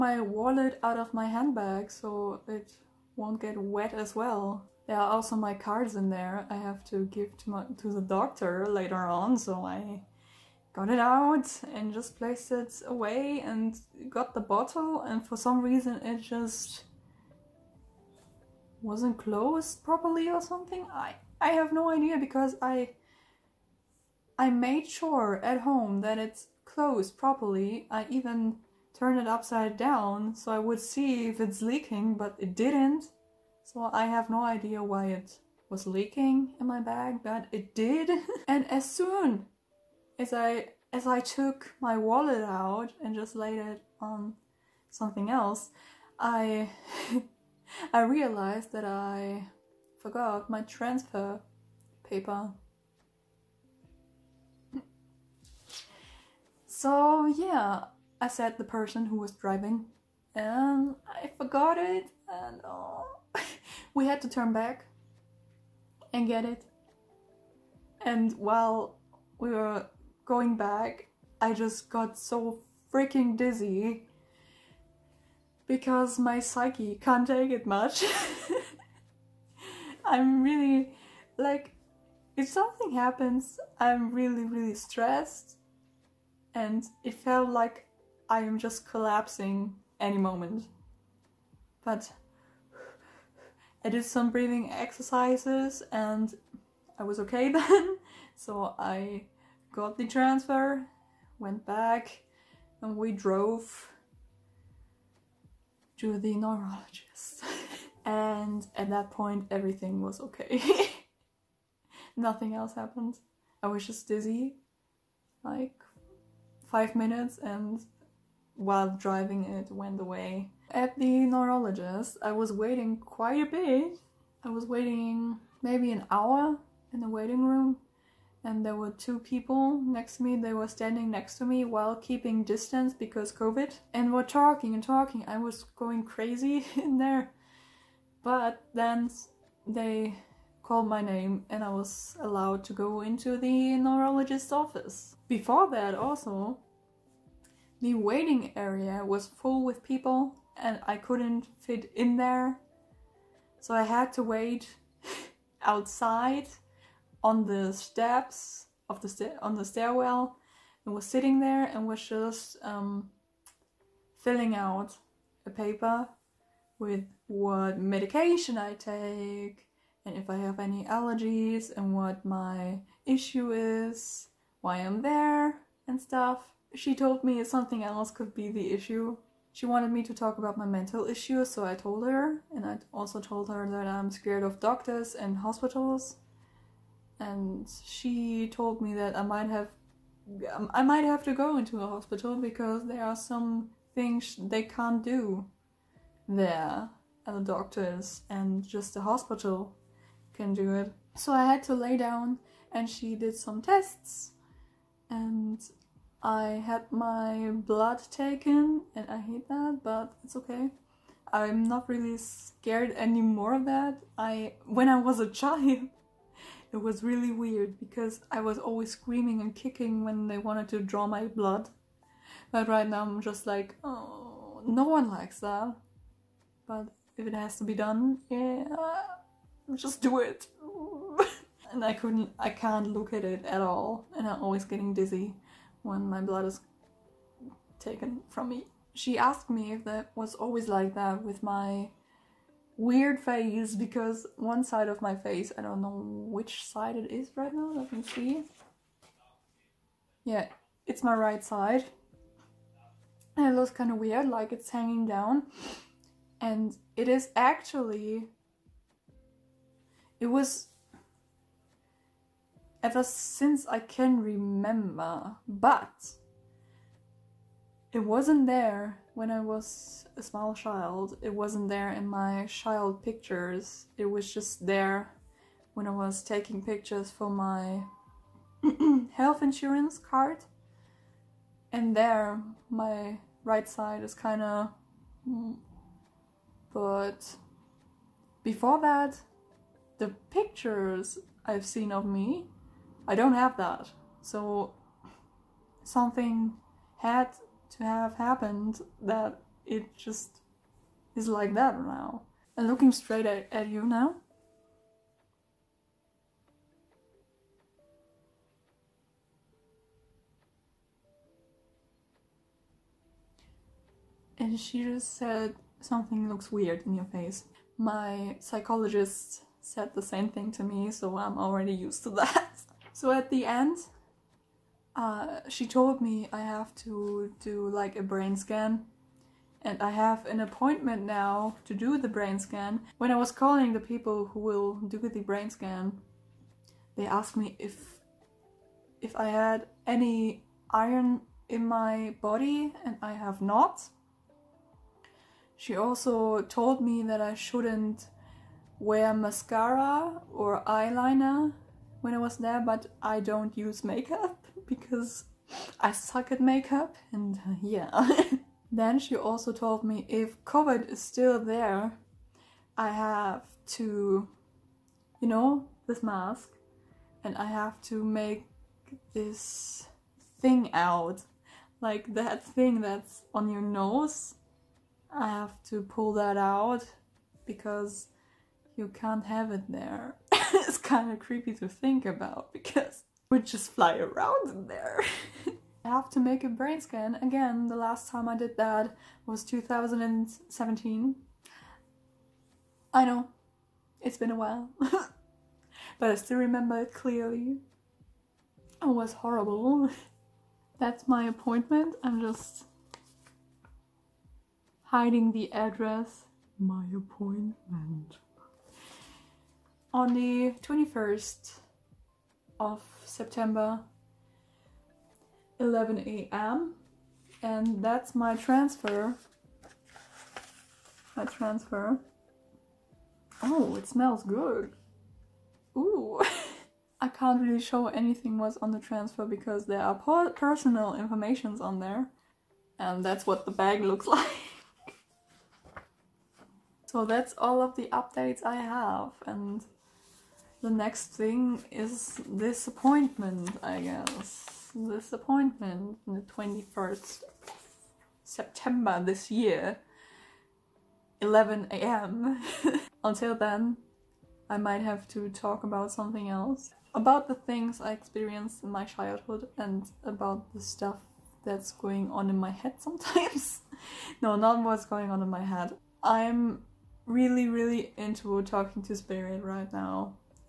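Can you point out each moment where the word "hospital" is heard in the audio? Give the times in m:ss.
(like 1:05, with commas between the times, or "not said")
3:05, 3:11, 3:19.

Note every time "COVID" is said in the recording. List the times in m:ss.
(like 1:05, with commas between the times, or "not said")
2:13, 6:00.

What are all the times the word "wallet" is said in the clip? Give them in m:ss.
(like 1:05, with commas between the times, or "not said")
0:00, 0:41.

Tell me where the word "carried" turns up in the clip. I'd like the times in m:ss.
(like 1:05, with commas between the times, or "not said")
not said.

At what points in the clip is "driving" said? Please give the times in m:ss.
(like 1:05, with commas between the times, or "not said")
0:59, 1:58.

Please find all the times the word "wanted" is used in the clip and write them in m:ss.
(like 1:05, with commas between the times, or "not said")
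2:59, 3:40.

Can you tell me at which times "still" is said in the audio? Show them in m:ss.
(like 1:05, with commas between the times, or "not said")
6:01, 6:36.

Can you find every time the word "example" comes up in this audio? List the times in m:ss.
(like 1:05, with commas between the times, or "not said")
not said.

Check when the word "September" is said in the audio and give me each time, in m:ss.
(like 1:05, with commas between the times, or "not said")
6:53, 7:28.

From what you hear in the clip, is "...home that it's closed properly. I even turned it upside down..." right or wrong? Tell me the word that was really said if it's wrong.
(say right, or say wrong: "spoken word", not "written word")
right.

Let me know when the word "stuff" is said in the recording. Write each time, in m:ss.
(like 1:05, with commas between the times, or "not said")
2:55, 7:40.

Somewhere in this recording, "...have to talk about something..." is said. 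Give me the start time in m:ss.
7:34.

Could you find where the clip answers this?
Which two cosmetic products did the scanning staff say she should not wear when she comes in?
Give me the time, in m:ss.
5:49.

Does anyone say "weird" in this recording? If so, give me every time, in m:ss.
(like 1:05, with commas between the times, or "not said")
3:37, 4:02, 4:13, 5:16.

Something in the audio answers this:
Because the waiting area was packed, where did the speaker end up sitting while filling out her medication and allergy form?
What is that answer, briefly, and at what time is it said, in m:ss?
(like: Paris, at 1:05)
the stairwell, at 2:39.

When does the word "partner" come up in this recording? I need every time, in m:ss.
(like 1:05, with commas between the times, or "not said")
not said.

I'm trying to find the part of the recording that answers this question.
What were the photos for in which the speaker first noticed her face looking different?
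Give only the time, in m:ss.
4:39.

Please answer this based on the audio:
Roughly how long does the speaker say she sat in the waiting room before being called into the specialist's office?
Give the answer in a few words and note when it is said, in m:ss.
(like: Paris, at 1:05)
an hour, at 2:05.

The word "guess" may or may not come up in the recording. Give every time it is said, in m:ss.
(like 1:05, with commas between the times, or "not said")
7:23.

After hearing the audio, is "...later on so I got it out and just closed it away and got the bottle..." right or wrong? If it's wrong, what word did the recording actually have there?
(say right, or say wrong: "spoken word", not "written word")
wrong: "placed", not "closed".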